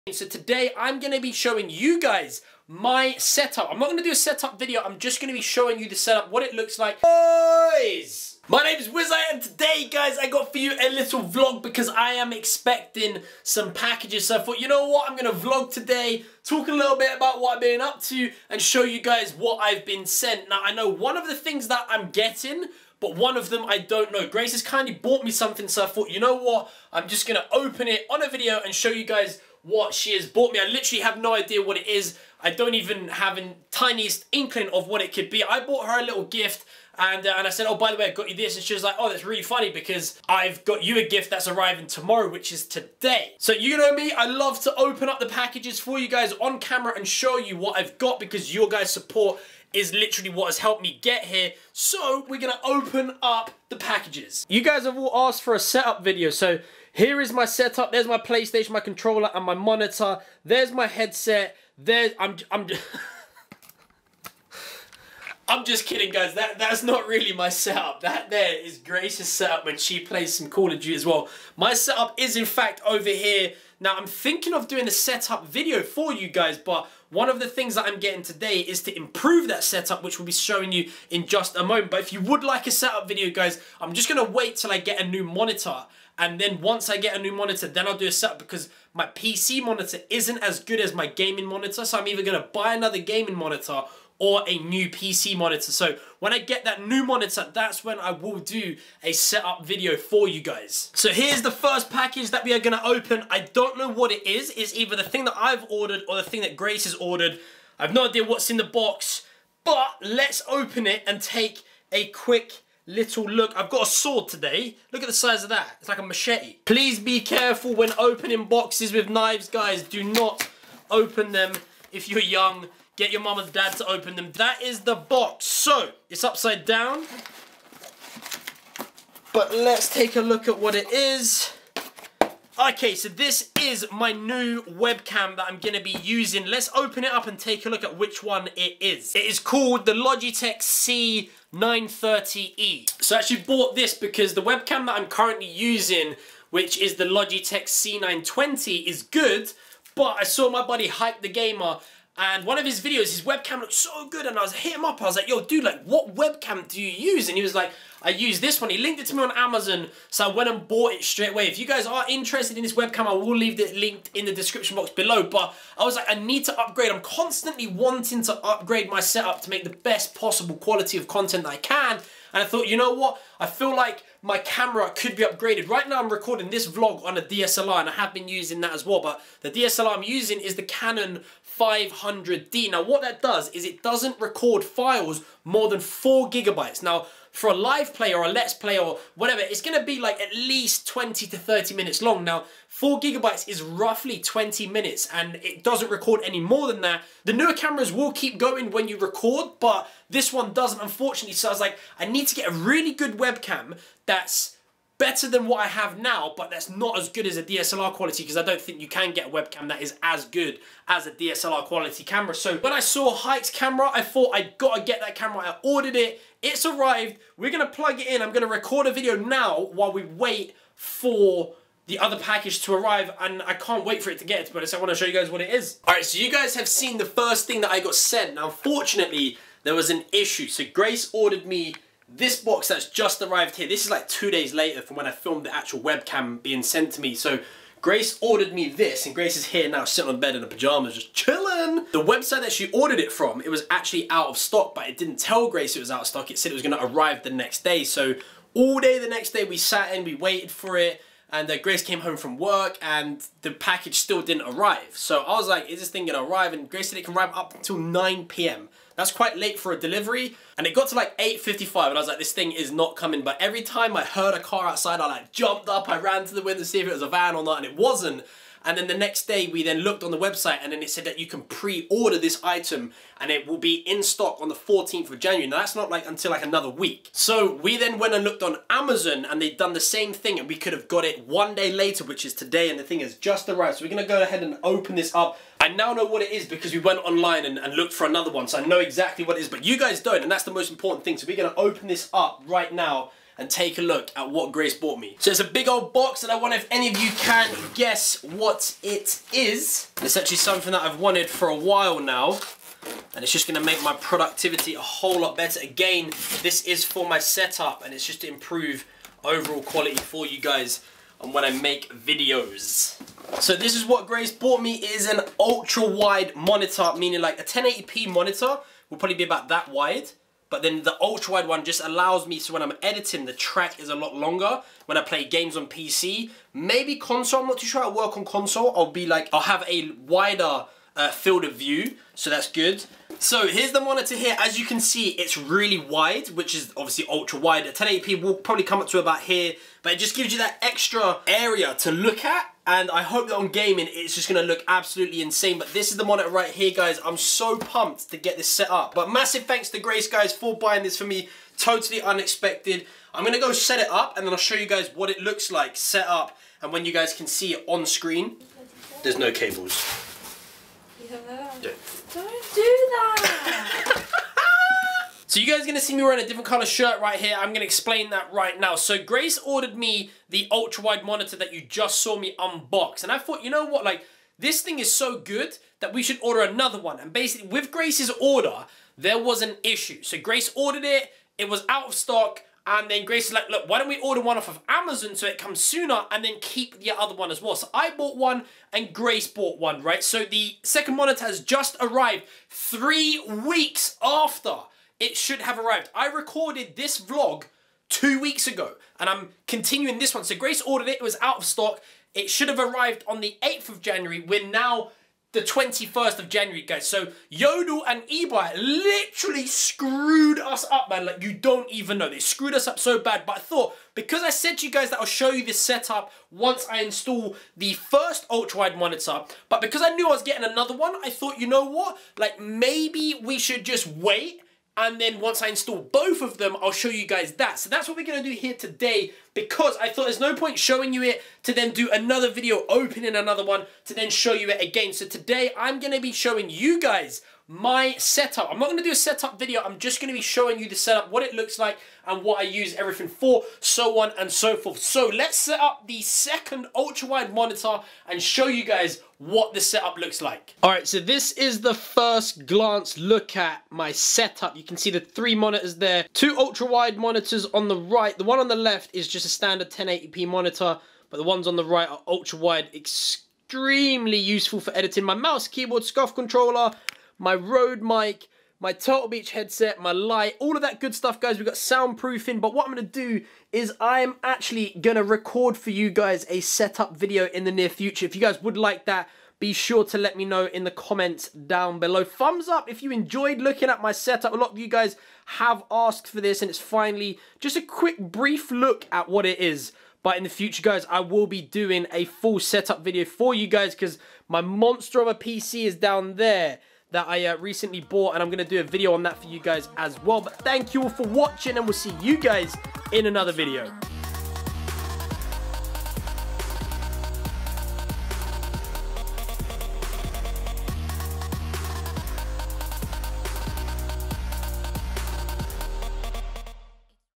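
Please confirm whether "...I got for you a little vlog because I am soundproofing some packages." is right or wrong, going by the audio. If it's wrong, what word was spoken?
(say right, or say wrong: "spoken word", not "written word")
wrong: "expecting", not "soundproofing".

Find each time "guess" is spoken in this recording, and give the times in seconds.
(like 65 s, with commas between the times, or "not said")
297 s.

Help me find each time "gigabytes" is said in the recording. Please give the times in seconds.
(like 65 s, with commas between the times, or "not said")
186 s, 192 s.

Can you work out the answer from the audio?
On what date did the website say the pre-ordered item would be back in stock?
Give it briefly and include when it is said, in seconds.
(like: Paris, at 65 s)
14th of January, at 274 s.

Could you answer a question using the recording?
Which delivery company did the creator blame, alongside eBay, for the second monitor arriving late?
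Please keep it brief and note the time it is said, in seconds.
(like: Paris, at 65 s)
Yodel, at 407 s.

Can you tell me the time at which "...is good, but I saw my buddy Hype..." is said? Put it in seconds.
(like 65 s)
148 s.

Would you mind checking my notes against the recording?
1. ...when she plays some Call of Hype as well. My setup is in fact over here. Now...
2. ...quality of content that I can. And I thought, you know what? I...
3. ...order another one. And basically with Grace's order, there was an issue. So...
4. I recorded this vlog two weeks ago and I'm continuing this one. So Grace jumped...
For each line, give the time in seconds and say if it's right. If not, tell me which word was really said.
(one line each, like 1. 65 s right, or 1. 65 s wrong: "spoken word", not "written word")
1. 69 s wrong: "Duty", not "Hype"
2. 170 s right
3. 376 s right
4. 395 s wrong: "ordered", not "jumped".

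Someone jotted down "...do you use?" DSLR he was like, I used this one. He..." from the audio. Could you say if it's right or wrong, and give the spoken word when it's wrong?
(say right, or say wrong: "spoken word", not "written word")
wrong: "And", not "DSLR".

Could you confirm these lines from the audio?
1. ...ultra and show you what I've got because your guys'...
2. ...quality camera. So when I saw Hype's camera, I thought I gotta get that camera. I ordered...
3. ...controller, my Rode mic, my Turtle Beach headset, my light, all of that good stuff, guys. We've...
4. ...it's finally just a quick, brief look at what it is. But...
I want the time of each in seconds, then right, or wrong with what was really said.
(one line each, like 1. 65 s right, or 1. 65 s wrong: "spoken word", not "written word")
1. 46 s wrong: "camera", not "ultra"
2. 211 s right
3. 466 s right
4. 486 s right.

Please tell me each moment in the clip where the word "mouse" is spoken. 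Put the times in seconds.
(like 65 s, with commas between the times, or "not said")
465 s.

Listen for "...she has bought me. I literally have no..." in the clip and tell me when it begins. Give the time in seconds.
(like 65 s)
29 s.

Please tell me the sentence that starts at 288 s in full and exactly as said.
So I know exactly what it is, but you guys don't.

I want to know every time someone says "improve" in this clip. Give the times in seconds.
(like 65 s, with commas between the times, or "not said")
78 s, 308 s.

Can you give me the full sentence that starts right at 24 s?
Grace has kindly bought me something, so I thought, you know what?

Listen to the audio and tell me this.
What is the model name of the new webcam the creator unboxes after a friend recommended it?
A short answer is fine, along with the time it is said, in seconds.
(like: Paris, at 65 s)
Logitech C930E, at 139 s.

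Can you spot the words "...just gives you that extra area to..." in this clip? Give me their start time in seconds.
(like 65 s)
339 s.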